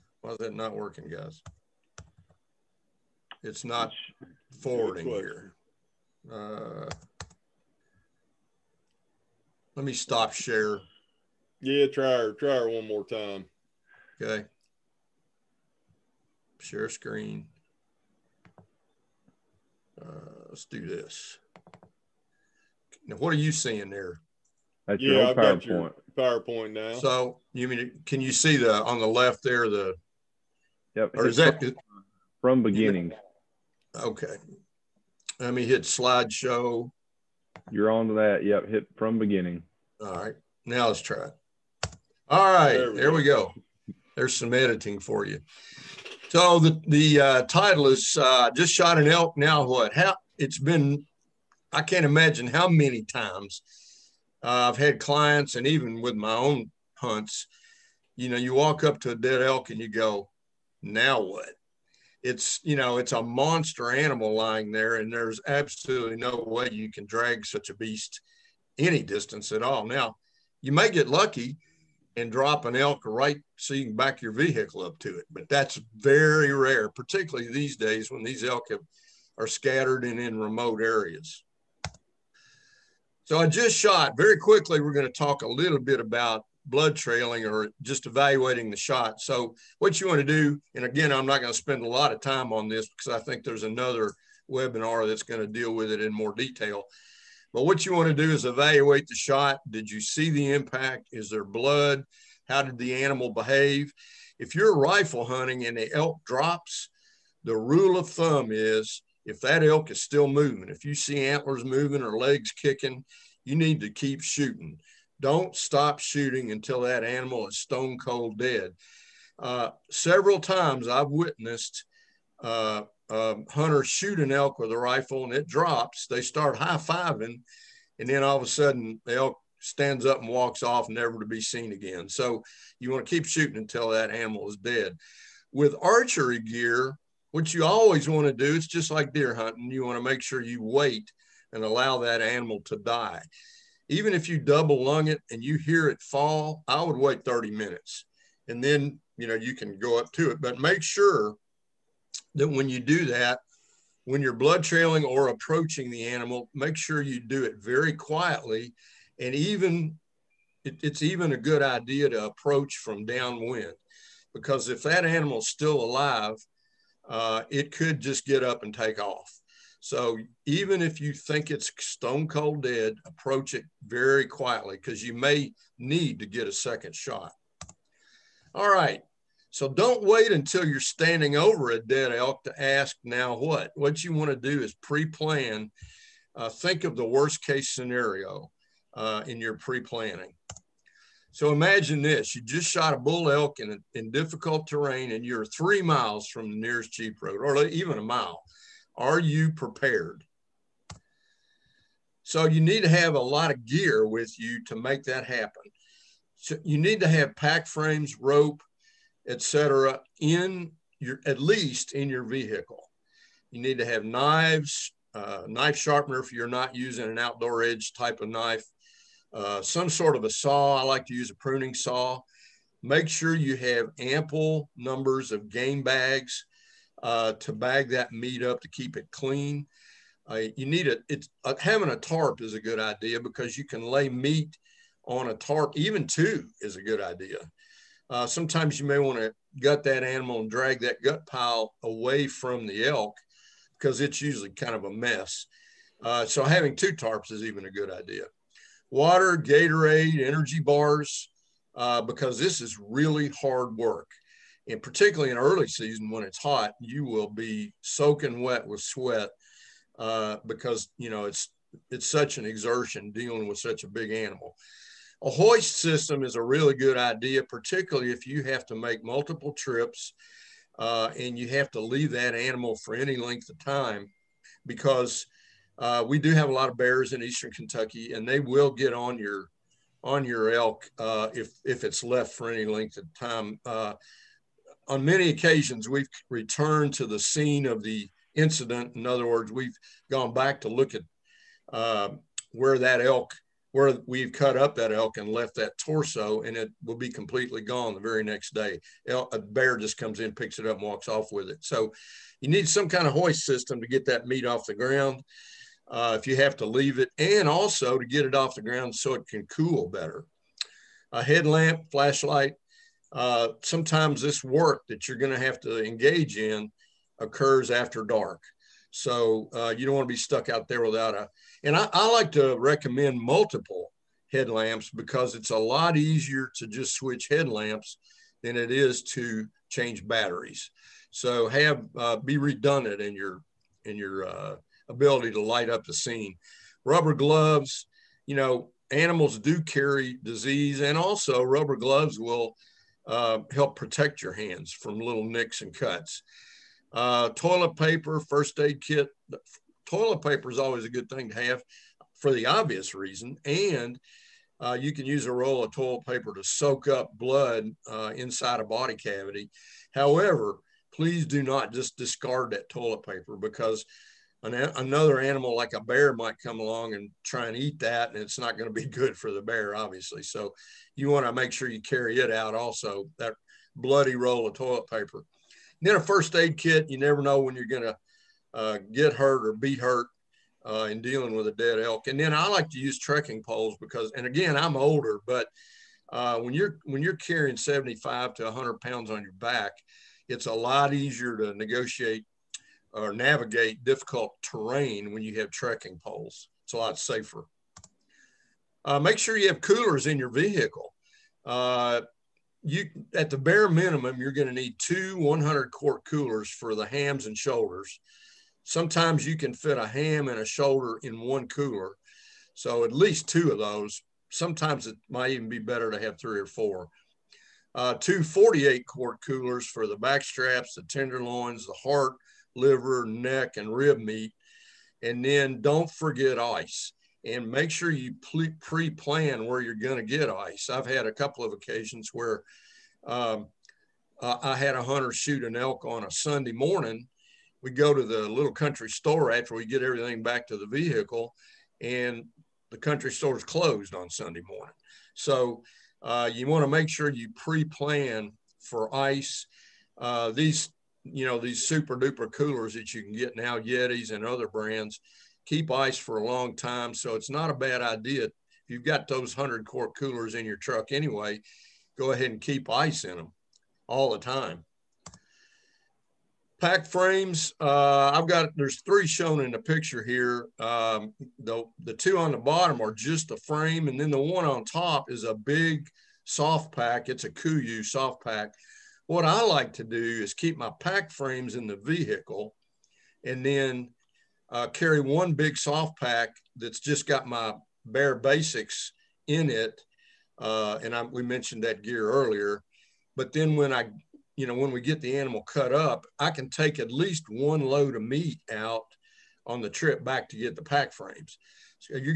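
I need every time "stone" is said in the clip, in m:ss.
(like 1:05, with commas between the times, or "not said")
1:57, 2:51.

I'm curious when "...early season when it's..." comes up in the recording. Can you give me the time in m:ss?
4:15.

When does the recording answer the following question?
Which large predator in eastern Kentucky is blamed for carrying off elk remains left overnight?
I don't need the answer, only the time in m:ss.
4:36.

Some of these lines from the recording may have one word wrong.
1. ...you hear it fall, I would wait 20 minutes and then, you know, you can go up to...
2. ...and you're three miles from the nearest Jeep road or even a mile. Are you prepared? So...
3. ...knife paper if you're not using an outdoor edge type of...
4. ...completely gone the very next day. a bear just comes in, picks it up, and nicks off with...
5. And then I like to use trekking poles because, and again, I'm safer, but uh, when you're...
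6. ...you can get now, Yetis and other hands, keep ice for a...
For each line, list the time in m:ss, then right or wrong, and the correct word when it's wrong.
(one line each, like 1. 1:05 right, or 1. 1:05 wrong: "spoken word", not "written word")
1. 2:25 wrong: "30", not "20"
2. 3:15 right
3. 3:35 wrong: "sharpener", not "paper"
4. 4:57 wrong: "walks", not "nicks"
5. 6:22 wrong: "older", not "safer"
6. 7:32 wrong: "brands", not "hands".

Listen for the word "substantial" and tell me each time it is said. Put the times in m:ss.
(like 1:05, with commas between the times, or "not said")
not said.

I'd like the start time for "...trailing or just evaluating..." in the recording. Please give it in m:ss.
1:26.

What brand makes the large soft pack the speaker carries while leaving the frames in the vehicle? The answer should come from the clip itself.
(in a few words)
Kuiu.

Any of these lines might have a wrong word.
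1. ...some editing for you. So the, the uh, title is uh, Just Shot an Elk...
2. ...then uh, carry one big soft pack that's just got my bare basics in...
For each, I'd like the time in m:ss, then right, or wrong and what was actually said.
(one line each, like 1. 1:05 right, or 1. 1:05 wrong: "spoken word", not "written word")
1. 0:44 right
2. 8:03 right.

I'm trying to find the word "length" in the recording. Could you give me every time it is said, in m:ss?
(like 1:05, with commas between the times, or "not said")
4:33, 4:42.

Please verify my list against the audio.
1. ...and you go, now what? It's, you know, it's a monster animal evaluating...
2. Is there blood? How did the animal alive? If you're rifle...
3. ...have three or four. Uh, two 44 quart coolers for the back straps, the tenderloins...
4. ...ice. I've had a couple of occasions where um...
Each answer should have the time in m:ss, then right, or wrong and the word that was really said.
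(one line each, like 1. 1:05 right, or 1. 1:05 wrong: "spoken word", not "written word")
1. 0:59 wrong: "lying", not "evaluating"
2. 1:41 wrong: "behave", not "alive"
3. 6:56 wrong: "48", not "44"
4. 7:10 right.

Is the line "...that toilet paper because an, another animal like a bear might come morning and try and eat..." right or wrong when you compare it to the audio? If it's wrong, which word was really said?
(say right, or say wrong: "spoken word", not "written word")
wrong: "along", not "morning".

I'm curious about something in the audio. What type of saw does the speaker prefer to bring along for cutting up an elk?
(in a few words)
pruning saw.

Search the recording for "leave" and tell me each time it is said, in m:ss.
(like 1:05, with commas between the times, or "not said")
4:31, 5:06.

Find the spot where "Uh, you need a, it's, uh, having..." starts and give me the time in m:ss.
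3:50.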